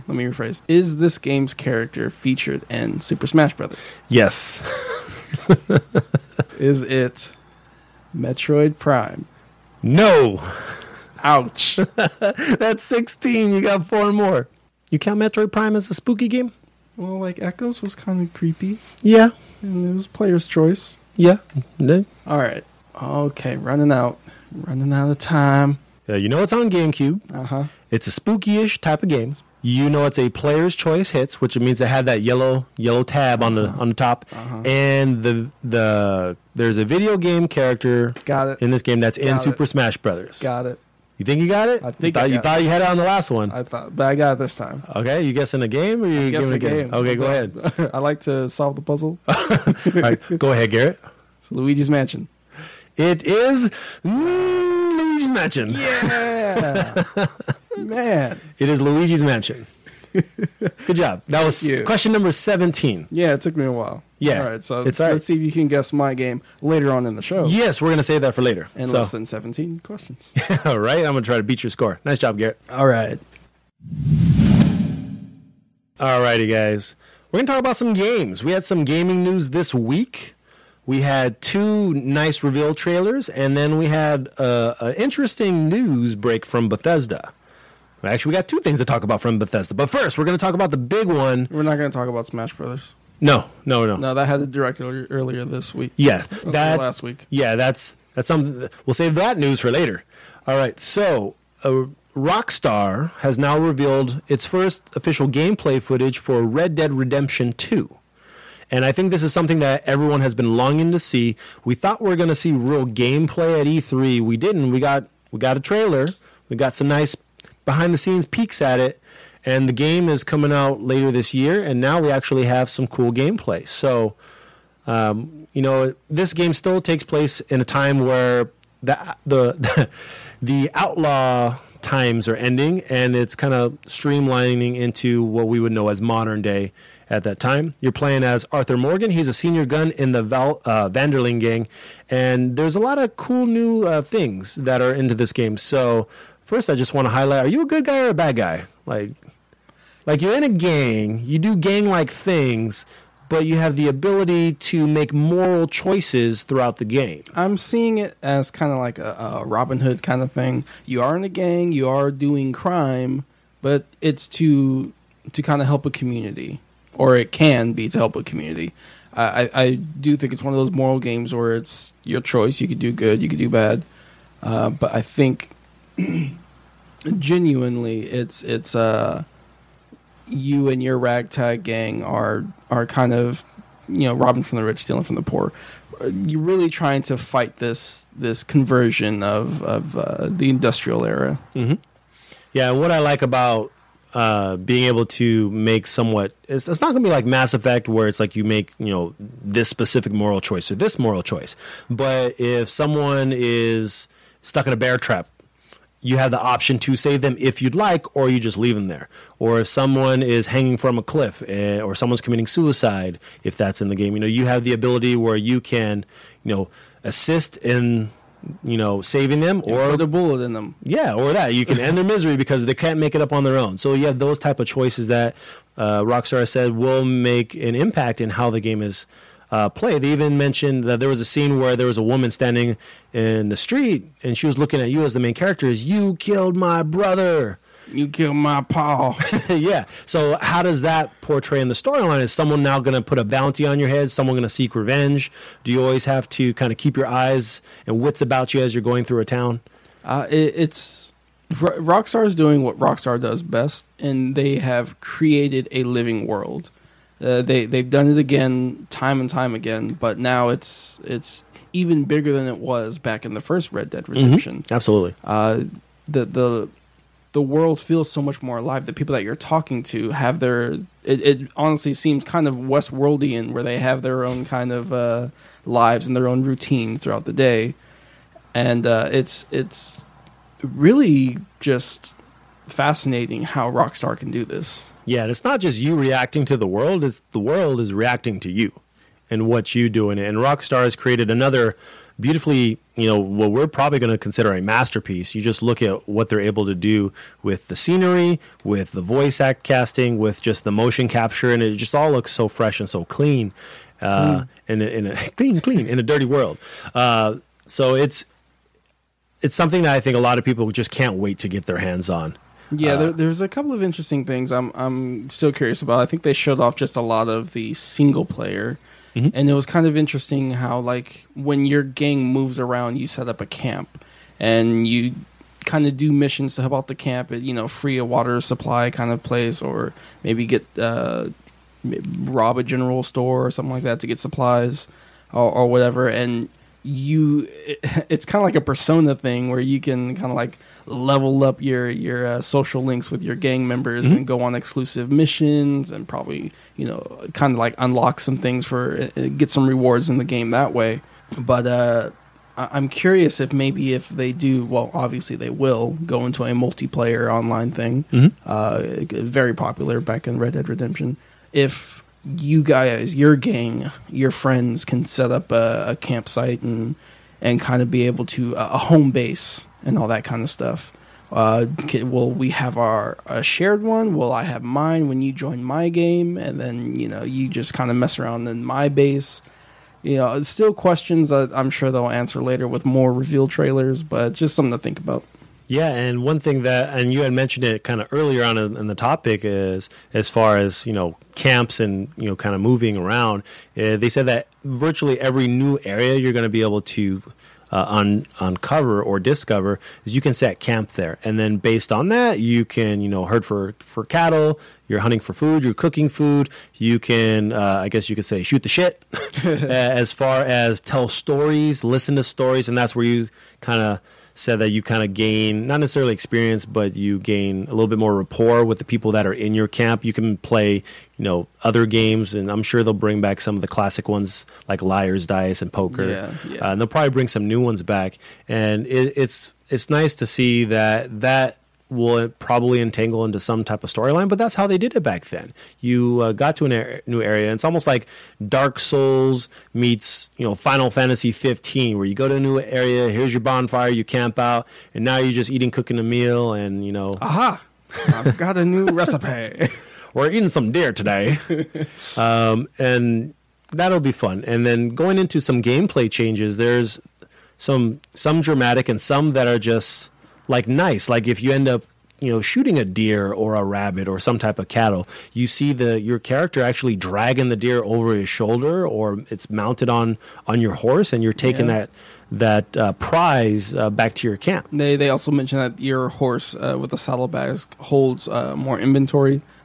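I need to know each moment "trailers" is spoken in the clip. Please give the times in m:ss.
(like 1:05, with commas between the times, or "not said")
1:22, 1:55, 6:23.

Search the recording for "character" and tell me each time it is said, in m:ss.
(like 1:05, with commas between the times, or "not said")
0:01, 0:37, 3:55, 7:46.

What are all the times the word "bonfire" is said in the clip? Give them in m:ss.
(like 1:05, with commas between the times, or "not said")
7:23.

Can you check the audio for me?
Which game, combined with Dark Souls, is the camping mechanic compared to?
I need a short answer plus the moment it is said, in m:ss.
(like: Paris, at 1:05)
Final Fantasy 15, at 7:20.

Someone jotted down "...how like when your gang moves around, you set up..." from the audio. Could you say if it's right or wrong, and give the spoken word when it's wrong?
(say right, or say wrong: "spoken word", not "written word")
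right.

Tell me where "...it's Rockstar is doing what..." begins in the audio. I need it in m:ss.
4:10.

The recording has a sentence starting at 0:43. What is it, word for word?
I thought, but I got it this time.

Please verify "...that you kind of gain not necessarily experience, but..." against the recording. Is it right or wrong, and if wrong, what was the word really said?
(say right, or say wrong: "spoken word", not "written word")
right.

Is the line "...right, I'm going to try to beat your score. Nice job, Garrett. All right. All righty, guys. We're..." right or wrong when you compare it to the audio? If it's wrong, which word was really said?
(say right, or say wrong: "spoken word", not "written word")
right.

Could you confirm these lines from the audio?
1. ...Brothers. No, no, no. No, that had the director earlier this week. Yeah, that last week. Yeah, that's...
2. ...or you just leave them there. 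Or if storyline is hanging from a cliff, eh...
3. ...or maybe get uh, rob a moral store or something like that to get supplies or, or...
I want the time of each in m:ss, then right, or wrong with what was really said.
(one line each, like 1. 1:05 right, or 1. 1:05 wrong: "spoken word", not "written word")
1. 1:32 right
2. 3:28 wrong: "someone", not "storyline"
3. 5:29 wrong: "general", not "moral".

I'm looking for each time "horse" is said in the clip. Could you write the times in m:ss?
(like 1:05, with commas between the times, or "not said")
7:50, 7:56.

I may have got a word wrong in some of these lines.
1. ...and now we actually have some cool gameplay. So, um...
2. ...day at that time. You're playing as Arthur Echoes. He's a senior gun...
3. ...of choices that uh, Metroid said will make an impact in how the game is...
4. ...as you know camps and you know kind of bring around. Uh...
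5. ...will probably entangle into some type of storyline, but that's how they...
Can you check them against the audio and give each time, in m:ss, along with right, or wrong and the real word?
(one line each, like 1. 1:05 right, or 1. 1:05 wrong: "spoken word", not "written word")
1. 2:01 right
2. 2:16 wrong: "Morgan", not "Echoes"
3. 3:44 wrong: "Rockstar", not "Metroid"
4. 6:30 wrong: "moving", not "bring"
5. 7:11 right.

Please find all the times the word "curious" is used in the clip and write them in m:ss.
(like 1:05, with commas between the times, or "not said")
5:15, 5:52.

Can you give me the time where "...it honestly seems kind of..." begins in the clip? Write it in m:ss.
4:31.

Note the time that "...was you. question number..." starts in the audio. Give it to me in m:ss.
1:01.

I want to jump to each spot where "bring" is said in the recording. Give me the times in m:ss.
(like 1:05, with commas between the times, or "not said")
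7:02, 7:07.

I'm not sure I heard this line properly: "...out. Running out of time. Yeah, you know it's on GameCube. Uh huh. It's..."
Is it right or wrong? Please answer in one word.
right.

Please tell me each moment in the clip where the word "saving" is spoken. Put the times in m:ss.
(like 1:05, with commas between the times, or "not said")
3:39.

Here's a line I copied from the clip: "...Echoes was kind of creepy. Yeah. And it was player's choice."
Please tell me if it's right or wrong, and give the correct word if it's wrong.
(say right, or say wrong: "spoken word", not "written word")
right.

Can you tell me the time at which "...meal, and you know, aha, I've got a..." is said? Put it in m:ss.
7:26.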